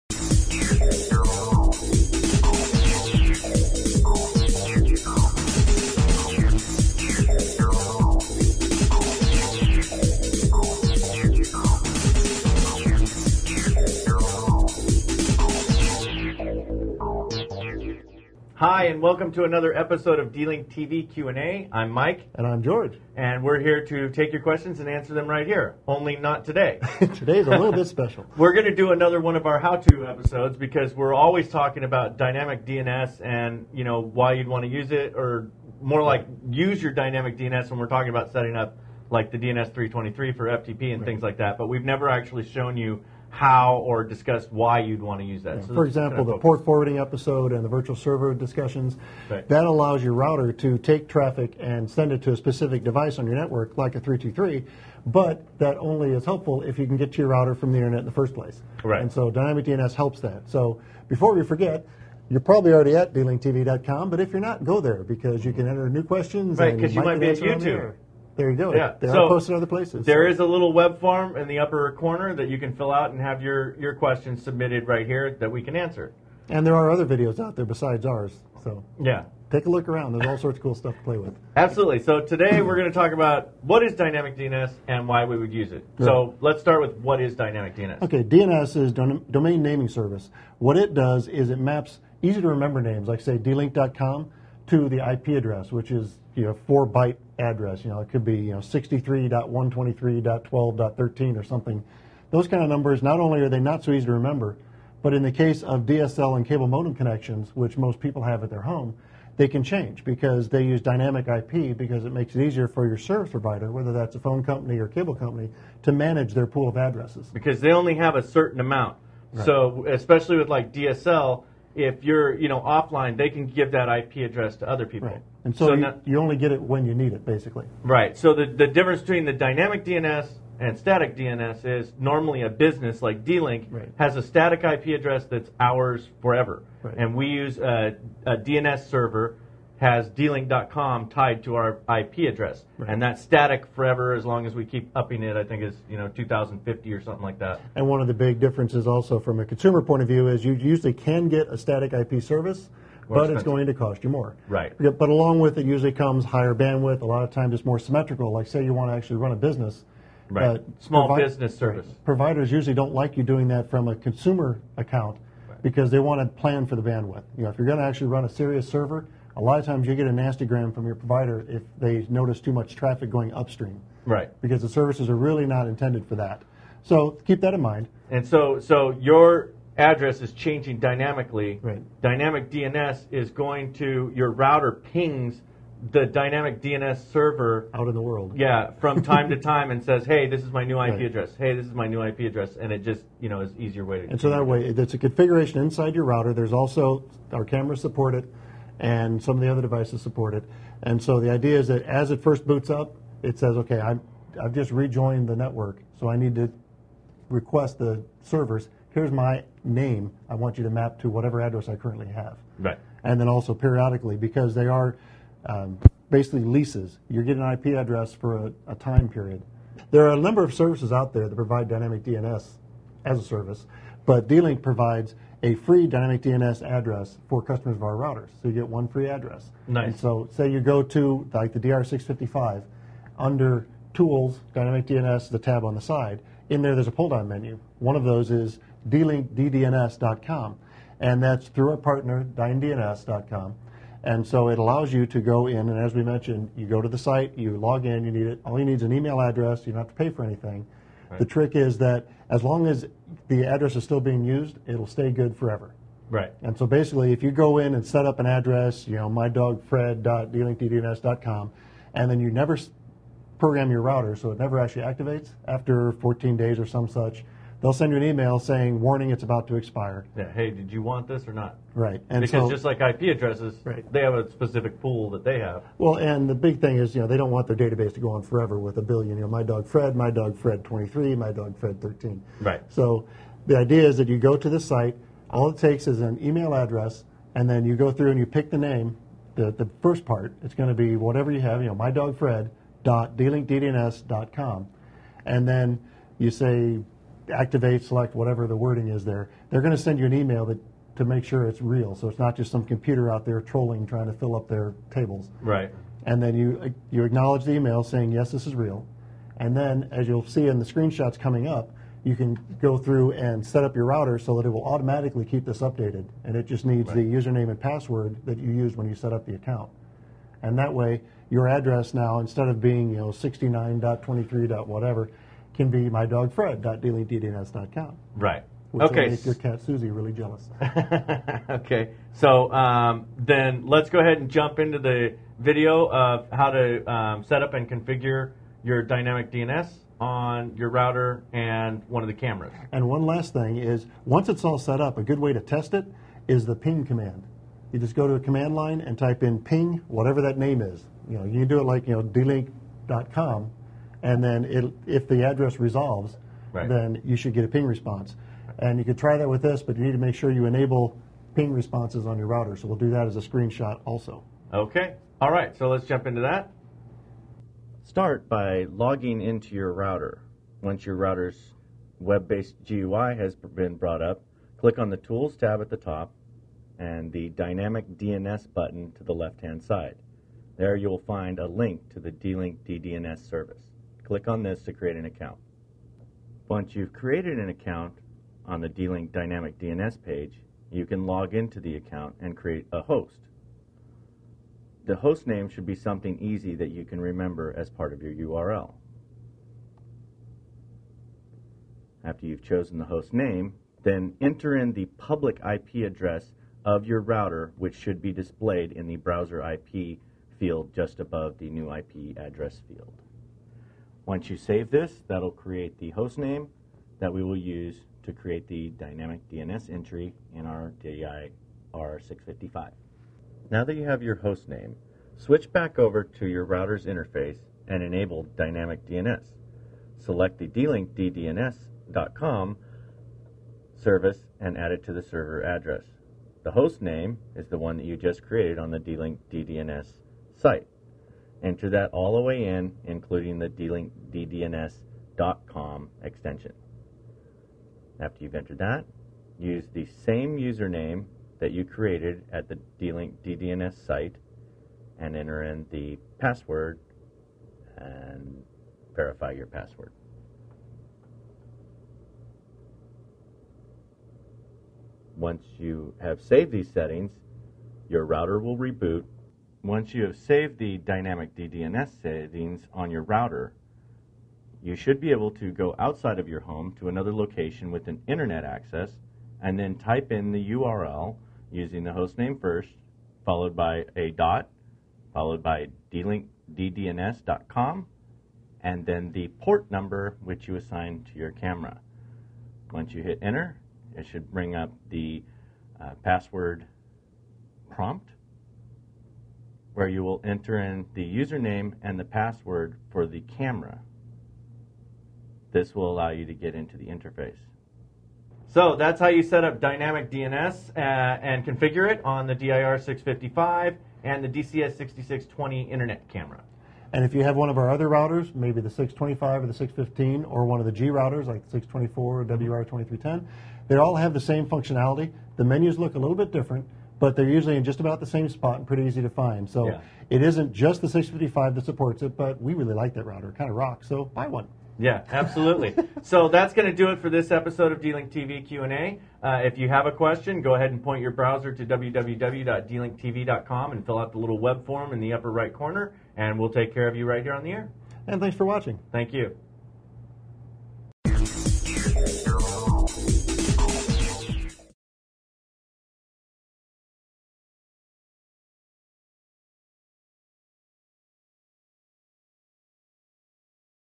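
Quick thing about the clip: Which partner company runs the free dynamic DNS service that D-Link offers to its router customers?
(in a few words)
DynDNS.com.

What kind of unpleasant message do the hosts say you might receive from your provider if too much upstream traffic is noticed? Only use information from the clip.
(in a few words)
Nastygram.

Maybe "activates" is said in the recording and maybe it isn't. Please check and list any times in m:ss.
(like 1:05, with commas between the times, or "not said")
4:24, 4:57.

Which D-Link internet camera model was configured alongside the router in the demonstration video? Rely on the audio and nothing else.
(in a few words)
DCS6620.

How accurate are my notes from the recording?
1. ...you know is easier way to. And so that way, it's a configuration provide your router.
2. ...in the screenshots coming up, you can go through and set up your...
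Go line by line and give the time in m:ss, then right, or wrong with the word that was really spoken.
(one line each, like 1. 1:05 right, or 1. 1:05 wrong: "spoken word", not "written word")
1. 3:13 wrong: "inside", not "provide"
2. 5:10 right.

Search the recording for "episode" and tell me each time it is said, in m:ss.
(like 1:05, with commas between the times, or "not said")
0:19, 0:30, 0:46, 8:57.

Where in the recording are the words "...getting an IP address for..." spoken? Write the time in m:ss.
3:37.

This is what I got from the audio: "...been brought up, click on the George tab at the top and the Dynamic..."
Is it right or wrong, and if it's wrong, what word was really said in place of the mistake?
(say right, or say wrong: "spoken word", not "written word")
wrong: "Tools", not "George".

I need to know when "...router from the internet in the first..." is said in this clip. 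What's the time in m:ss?
0:57.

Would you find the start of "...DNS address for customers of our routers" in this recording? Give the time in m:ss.
3:46.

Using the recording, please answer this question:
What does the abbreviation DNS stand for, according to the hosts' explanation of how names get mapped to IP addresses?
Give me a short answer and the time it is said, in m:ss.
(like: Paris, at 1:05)
Domain naming service, at 1:28.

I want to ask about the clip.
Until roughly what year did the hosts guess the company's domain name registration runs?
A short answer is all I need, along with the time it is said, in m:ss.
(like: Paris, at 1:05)
2050, at 2:26.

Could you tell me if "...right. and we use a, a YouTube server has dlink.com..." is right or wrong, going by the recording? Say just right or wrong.
wrong.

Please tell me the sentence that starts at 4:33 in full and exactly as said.
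they have a specific pool that they have.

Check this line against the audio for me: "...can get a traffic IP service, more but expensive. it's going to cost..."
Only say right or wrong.
wrong.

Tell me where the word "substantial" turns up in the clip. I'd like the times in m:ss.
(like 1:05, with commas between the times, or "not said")
not said.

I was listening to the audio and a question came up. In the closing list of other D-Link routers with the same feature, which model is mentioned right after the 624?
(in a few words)
WR2310.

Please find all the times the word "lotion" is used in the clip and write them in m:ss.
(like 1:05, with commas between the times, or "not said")
not said.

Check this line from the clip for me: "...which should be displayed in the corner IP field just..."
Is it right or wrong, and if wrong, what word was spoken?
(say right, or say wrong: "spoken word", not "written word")
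wrong: "browser", not "corner".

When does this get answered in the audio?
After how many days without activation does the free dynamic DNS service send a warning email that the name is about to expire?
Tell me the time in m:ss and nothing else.
4:25.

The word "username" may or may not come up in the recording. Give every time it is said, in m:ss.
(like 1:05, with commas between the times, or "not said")
5:17, 7:30, 8:21.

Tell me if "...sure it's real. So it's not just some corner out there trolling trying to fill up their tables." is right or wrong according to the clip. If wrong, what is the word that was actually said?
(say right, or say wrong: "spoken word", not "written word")
wrong: "computer", not "corner".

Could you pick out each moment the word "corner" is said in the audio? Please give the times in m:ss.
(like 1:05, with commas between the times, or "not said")
1:11, 9:05.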